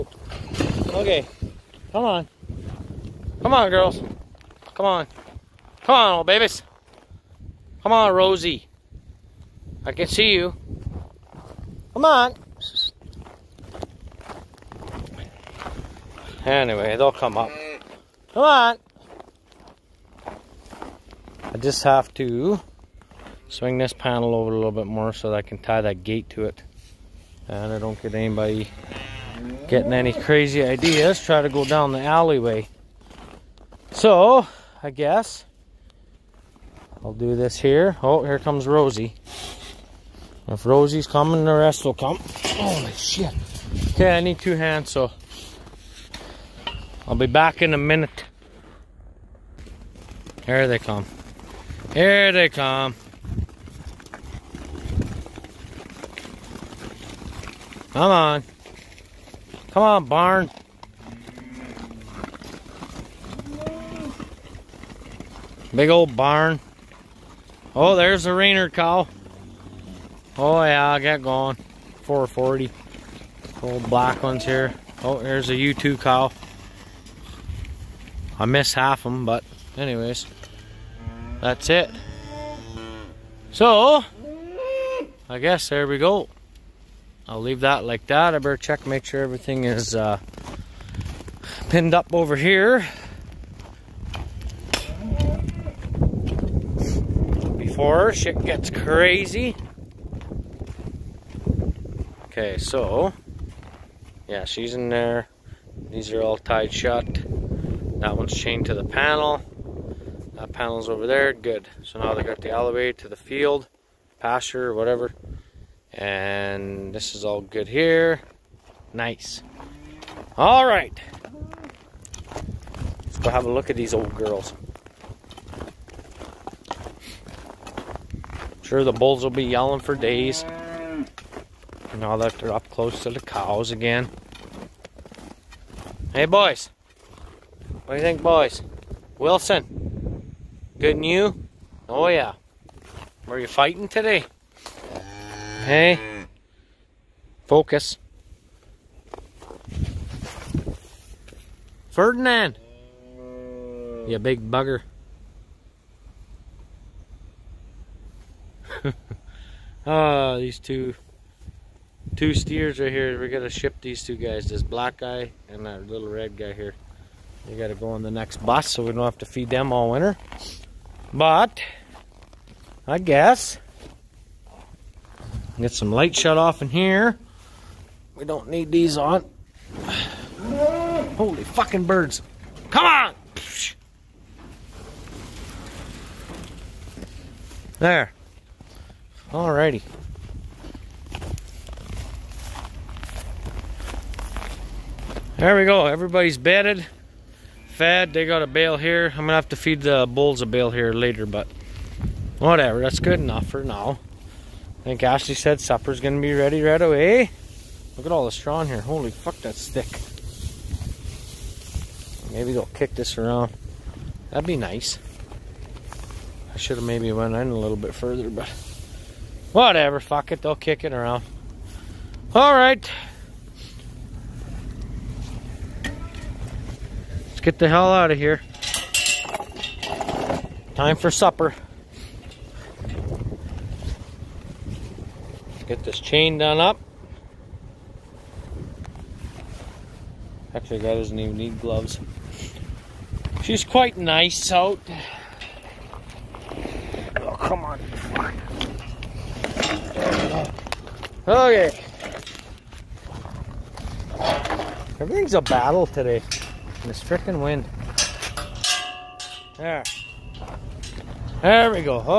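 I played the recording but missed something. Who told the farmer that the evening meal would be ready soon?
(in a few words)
Ashley.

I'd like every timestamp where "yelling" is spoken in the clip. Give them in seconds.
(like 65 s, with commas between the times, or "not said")
129 s.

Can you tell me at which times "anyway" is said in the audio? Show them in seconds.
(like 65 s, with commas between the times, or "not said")
16 s, 79 s.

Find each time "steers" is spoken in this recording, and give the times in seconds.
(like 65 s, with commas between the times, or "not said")
162 s.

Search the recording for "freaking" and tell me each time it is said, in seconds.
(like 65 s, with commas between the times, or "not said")
257 s.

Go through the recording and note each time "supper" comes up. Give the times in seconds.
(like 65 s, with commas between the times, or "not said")
205 s, 231 s.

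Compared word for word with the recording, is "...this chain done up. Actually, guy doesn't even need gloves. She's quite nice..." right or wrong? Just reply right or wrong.
right.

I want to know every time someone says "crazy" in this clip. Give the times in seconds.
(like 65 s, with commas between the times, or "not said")
30 s, 98 s.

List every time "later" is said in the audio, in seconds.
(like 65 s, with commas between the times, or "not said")
200 s.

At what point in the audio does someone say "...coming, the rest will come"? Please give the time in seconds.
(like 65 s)
41 s.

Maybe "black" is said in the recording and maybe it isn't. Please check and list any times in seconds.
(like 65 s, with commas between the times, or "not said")
73 s, 164 s.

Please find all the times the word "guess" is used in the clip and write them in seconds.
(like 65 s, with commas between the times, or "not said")
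34 s, 85 s, 172 s.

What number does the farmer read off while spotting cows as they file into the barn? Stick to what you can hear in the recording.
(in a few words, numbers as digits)
440.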